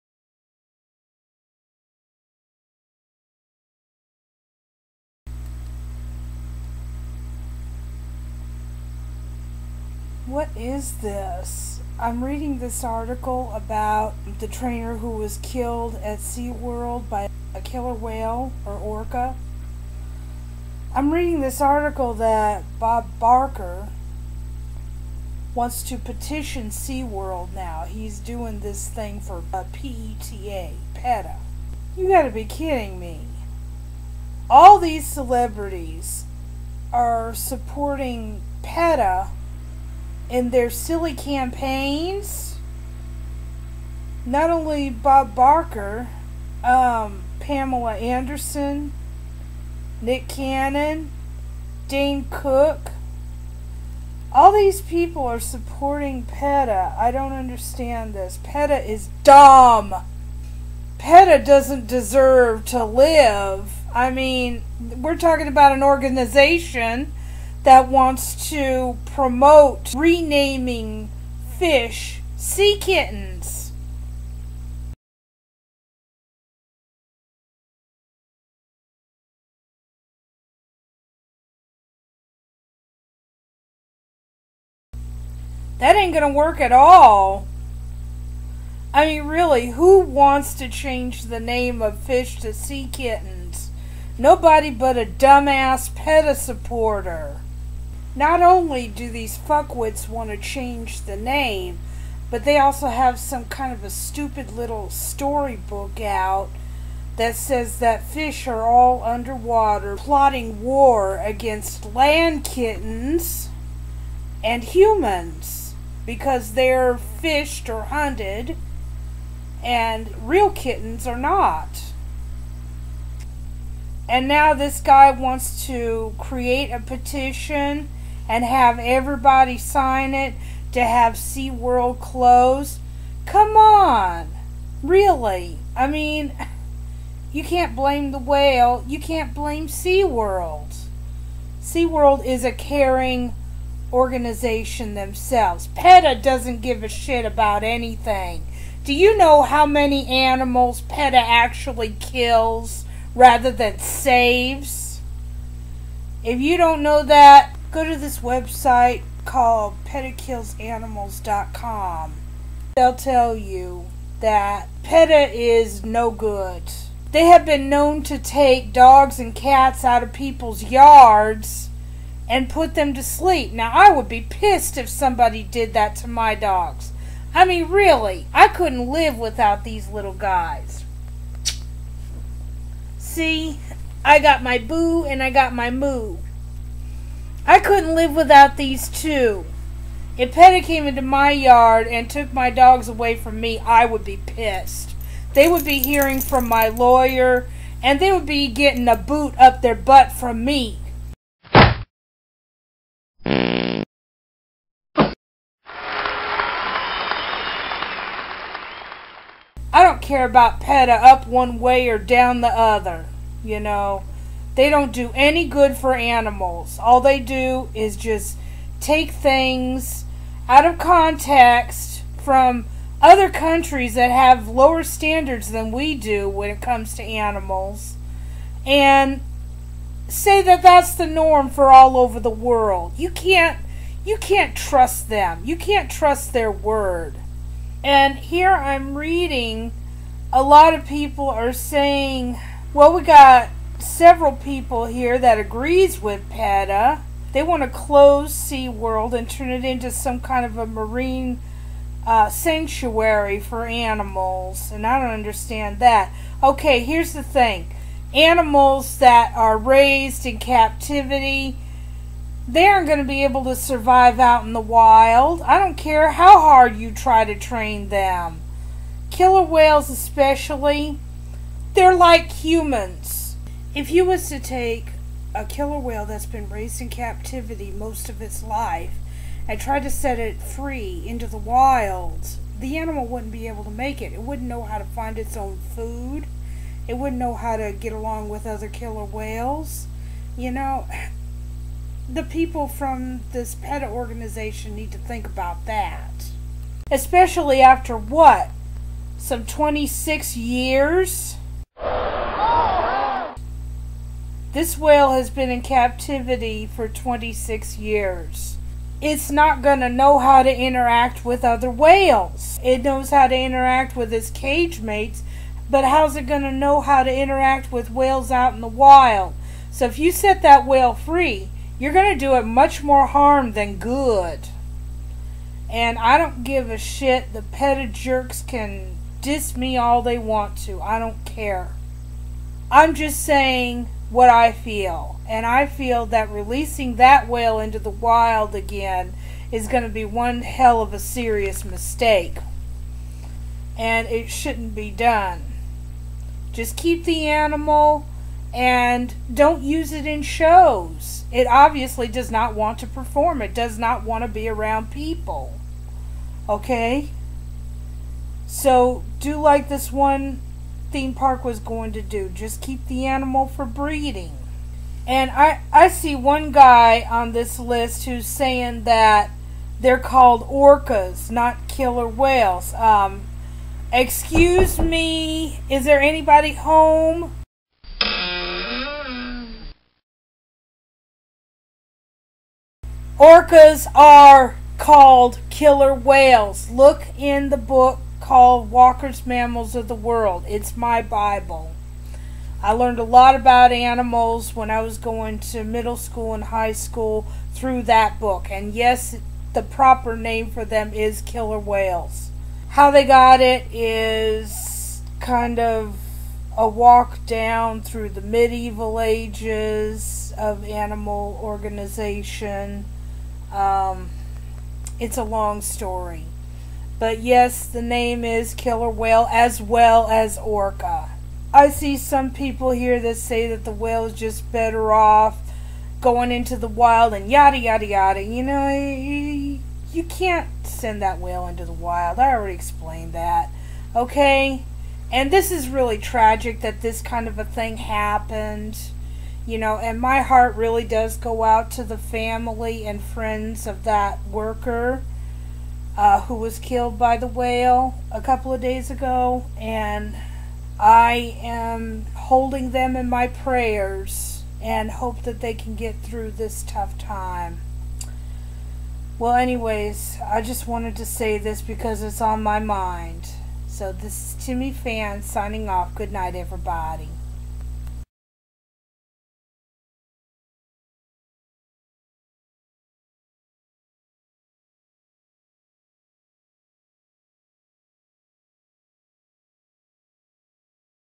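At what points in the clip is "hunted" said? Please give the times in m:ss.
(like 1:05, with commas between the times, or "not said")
1:57.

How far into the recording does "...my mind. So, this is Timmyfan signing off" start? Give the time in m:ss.
7:42.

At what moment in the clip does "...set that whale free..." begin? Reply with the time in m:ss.
5:20.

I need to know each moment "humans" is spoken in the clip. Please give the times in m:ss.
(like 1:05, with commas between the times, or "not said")
1:54, 4:32.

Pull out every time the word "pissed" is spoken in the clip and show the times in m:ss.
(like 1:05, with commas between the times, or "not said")
2:54, 3:14.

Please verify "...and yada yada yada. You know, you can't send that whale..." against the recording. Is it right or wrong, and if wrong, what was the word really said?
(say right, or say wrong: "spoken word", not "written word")
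right.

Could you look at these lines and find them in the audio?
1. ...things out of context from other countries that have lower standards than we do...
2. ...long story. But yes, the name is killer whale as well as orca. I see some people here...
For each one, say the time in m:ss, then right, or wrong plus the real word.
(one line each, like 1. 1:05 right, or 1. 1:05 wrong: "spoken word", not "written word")
1. 3:39 right
2. 6:55 right.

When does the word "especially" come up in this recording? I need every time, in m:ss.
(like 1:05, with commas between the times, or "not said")
4:29, 4:56.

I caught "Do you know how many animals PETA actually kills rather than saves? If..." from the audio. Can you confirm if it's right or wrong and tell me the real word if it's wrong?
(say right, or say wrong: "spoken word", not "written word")
right.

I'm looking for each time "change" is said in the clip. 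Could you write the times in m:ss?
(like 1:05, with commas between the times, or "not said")
1:30, 1:40.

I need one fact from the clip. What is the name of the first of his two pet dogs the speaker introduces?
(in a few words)
Boo.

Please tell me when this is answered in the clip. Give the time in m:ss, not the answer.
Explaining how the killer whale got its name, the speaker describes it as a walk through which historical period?
6:48.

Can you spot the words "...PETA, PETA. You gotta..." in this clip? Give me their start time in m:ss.
0:29.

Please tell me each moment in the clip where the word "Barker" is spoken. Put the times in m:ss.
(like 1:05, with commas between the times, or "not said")
0:23, 0:45.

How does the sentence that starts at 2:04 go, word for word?
And now this guy wants to create a petition and have everybody sign it to have SeaWorld closed.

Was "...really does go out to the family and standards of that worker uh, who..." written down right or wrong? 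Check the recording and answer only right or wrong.
wrong.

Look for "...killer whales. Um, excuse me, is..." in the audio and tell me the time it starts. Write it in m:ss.
6:11.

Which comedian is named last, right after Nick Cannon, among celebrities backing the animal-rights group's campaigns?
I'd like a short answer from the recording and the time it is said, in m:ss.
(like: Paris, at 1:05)
Dane Cook, at 0:51.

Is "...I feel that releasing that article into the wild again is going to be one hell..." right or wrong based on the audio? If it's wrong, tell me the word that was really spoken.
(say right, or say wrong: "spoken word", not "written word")
wrong: "whale", not "article".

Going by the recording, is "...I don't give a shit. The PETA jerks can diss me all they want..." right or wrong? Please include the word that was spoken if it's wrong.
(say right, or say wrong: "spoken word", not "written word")
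right.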